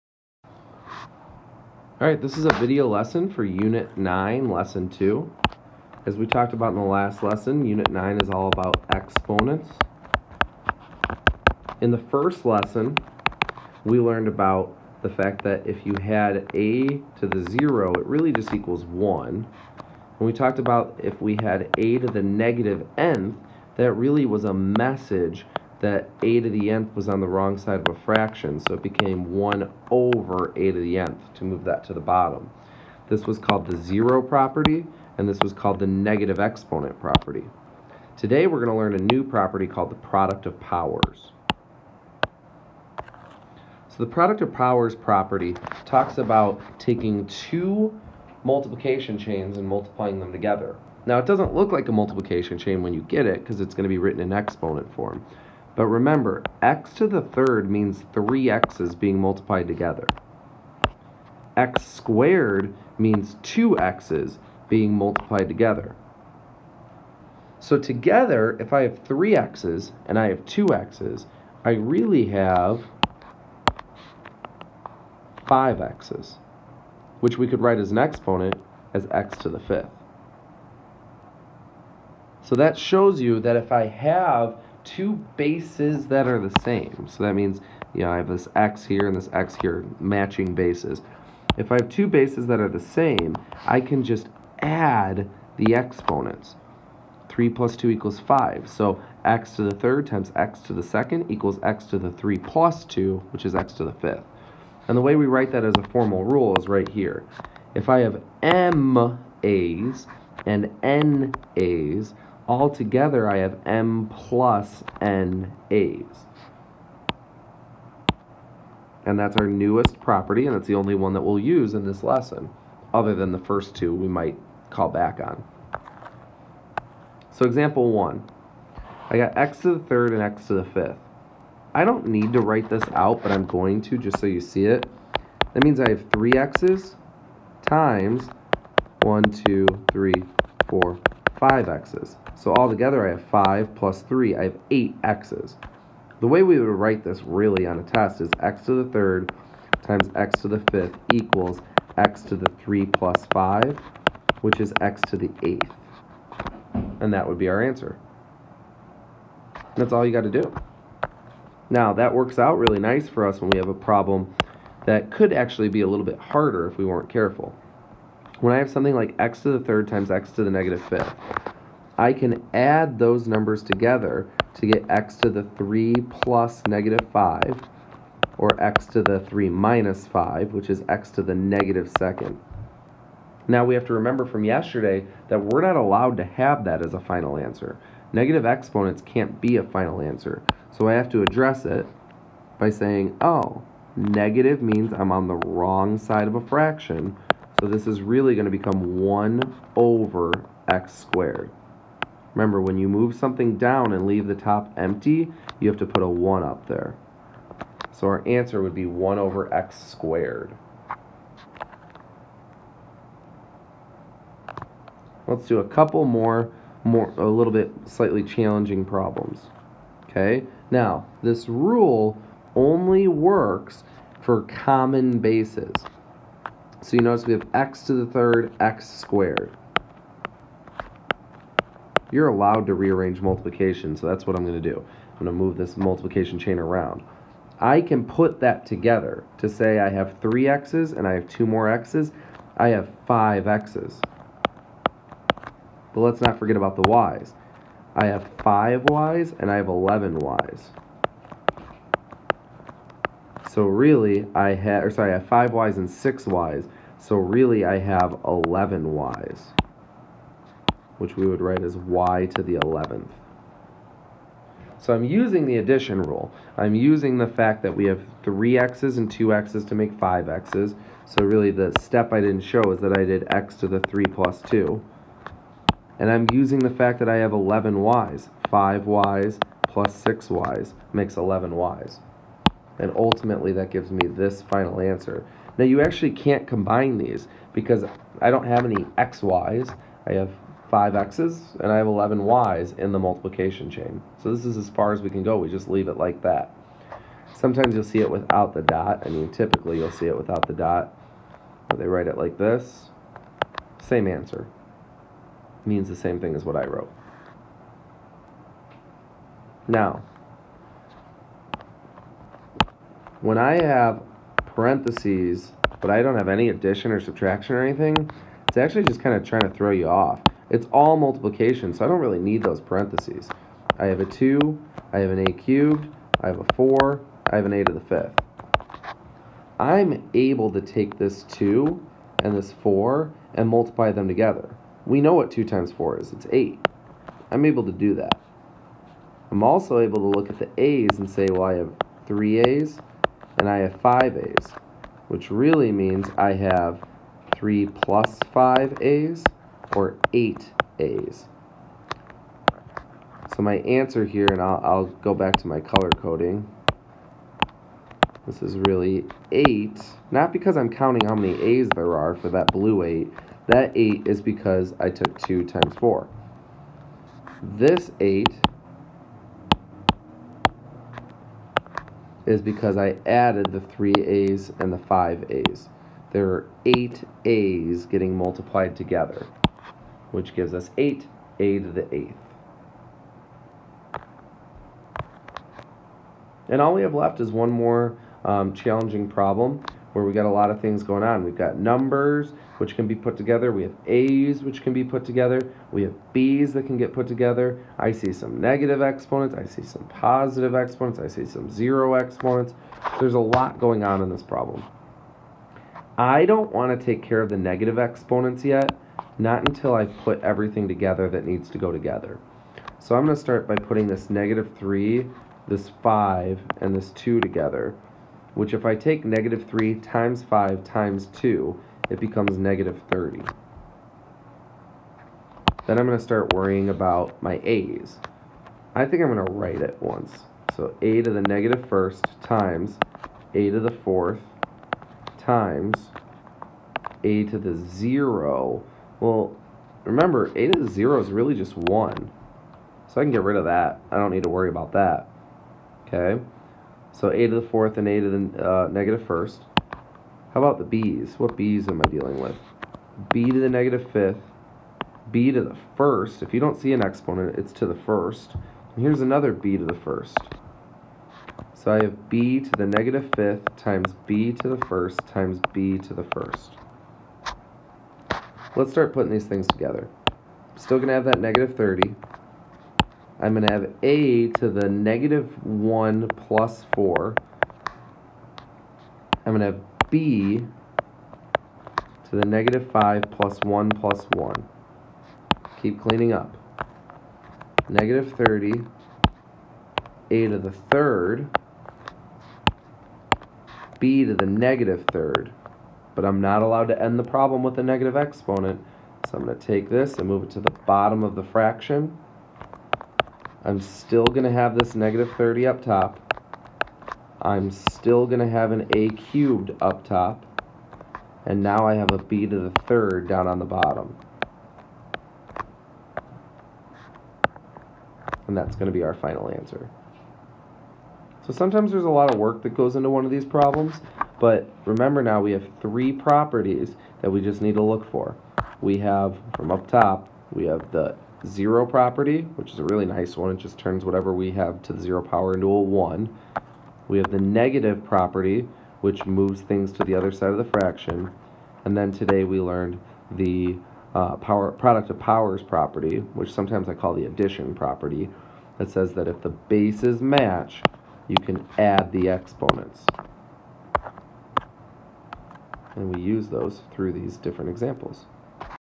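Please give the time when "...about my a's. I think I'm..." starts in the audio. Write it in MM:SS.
07:06.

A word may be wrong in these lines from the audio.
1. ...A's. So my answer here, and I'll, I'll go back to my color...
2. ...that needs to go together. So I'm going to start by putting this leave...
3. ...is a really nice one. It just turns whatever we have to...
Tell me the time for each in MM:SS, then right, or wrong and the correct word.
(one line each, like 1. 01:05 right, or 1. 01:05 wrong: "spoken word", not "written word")
1. 05:50 right
2. 06:51 wrong: "negative", not "leave"
3. 08:52 right.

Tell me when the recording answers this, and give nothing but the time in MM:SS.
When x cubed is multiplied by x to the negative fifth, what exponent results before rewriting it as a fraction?
03:01.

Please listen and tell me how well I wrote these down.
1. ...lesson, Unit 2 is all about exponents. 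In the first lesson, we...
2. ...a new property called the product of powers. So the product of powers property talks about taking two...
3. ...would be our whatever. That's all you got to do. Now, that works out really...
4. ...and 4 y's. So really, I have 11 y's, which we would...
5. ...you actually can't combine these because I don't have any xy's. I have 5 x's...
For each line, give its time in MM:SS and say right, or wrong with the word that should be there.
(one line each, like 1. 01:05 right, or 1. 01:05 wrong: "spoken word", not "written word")
1. 00:07 wrong: "9", not "2"
2. 00:38 right
3. 02:37 wrong: "answer", not "whatever"
4. 04:15 wrong: "6", not "4"
5. 04:45 right.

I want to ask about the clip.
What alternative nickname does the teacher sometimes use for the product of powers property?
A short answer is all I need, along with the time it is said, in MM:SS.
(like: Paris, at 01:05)
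addition property, at 09:07.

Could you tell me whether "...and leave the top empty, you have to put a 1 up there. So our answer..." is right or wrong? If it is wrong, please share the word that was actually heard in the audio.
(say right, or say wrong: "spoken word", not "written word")
right.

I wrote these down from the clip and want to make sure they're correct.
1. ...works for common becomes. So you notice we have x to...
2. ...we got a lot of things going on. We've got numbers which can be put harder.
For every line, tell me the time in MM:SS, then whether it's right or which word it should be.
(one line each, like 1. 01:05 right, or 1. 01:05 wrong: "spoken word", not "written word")
1. 03:43 wrong: "bases", not "becomes"
2. 06:30 wrong: "together", not "harder".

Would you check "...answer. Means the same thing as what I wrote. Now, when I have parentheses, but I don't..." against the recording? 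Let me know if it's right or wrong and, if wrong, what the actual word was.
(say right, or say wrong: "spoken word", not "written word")
right.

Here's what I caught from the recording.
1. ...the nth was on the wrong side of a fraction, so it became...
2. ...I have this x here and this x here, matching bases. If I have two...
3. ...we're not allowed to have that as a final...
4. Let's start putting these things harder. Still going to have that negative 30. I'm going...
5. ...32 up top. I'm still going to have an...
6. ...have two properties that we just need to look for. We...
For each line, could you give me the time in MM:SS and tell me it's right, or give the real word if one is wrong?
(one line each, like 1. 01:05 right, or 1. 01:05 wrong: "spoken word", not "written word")
1. 00:26 right
2. 01:28 right
3. 03:05 right
4. 07:48 wrong: "together", not "harder"
5. 08:25 wrong: "30", not "32"
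6. 08:45 wrong: "three", not "two".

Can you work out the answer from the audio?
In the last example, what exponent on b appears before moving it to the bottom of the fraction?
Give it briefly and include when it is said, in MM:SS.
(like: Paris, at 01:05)
negative third, at 08:14.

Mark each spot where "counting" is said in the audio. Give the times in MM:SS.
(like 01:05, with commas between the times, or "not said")
06:00.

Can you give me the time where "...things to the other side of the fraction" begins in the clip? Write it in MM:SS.
08:59.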